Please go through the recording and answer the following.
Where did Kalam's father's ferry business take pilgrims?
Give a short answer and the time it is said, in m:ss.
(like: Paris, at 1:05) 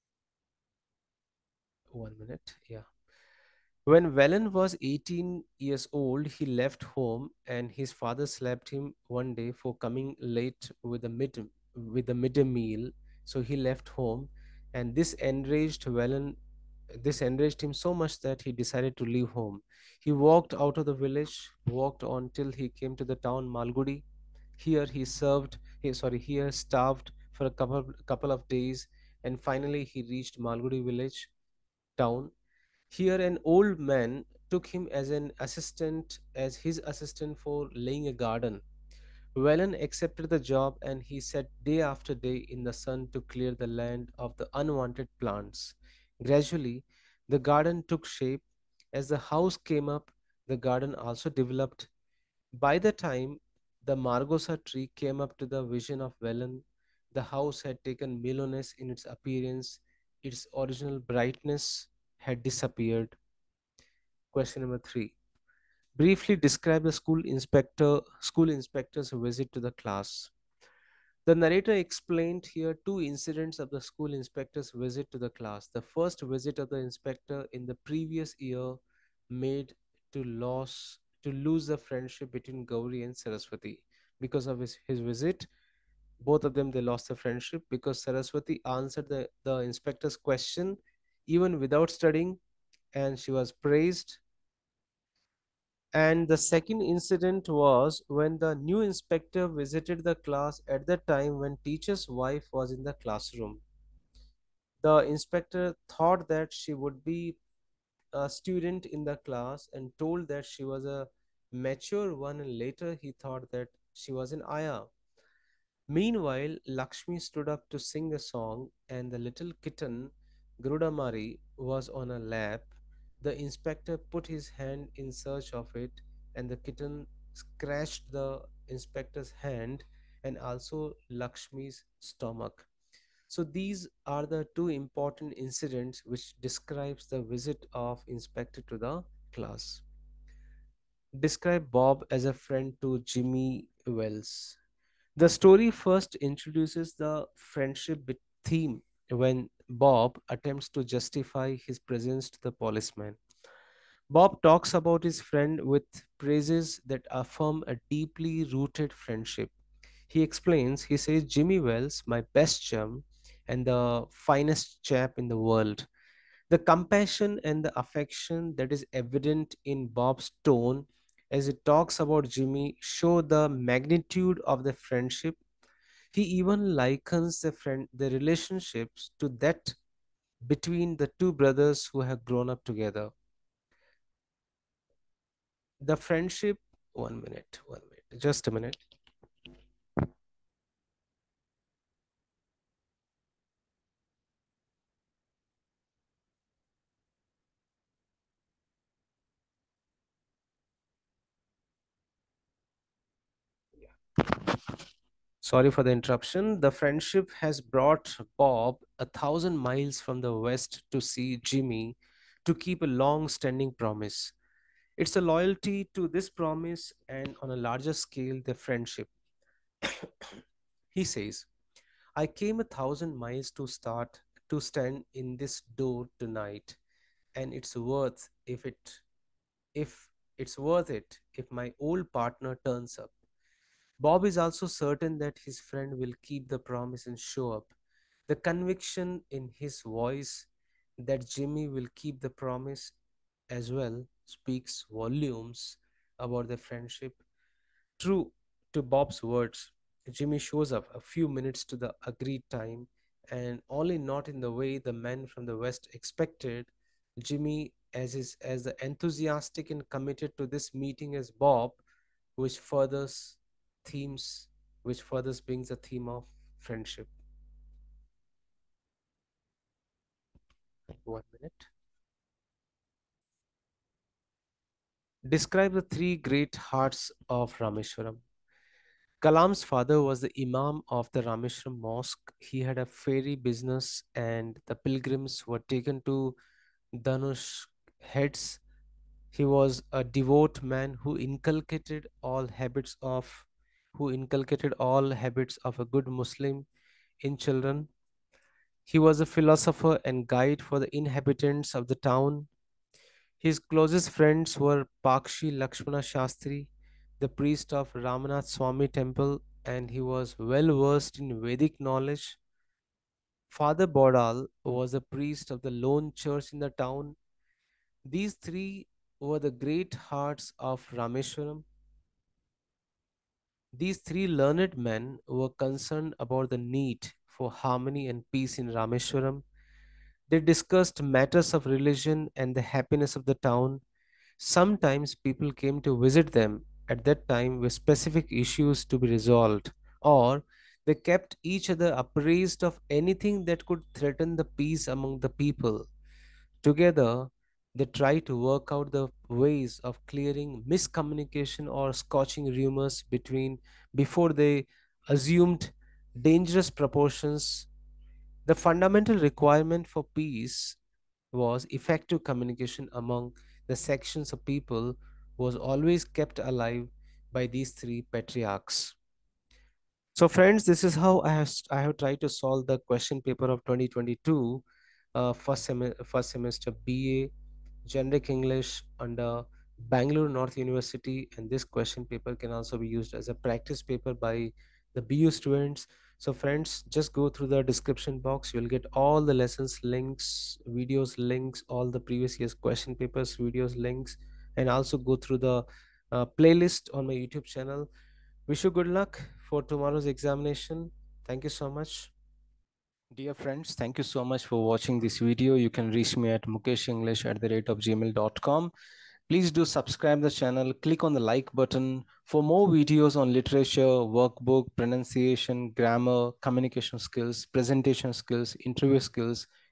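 Danush heads, at 4:46.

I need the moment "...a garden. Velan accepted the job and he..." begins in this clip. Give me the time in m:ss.
0:38.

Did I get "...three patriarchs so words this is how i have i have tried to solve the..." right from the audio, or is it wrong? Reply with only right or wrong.
wrong.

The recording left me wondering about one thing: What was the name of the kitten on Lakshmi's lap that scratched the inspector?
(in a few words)
Grudamari.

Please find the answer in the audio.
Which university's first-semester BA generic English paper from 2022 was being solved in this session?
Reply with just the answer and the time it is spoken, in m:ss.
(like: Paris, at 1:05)
Bangalore North University, at 6:19.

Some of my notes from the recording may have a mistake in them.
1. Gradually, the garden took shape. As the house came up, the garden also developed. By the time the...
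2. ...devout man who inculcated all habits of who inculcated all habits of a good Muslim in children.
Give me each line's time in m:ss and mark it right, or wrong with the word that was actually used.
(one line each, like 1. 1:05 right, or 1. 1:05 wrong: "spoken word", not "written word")
1. 0:46 right
2. 4:50 right.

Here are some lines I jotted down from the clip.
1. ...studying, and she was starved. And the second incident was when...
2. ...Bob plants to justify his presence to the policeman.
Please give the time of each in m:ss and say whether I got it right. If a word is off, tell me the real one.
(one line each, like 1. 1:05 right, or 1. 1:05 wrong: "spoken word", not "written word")
1. 1:31 wrong: "praised", not "starved"
2. 2:29 wrong: "attempts", not "plants".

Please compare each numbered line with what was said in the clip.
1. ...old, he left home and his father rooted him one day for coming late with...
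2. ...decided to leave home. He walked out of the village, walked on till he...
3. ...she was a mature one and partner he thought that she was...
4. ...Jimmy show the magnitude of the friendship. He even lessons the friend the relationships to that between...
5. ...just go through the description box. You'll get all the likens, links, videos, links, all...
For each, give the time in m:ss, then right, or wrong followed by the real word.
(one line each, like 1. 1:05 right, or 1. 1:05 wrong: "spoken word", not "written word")
1. 0:05 wrong: "slapped", not "rooted"
2. 0:18 right
3. 1:50 wrong: "later", not "partner"
4. 2:52 wrong: "likens", not "lessons"
5. 6:26 wrong: "lessons", not "likens".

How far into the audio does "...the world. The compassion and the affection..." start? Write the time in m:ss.
2:45.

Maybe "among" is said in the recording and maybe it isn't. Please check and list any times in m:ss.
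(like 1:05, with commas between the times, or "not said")
5:44, 6:02.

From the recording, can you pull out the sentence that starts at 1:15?
The first visit of the inspector in the previous year made to Loss to lose the friendship between Gauri and Saraswati.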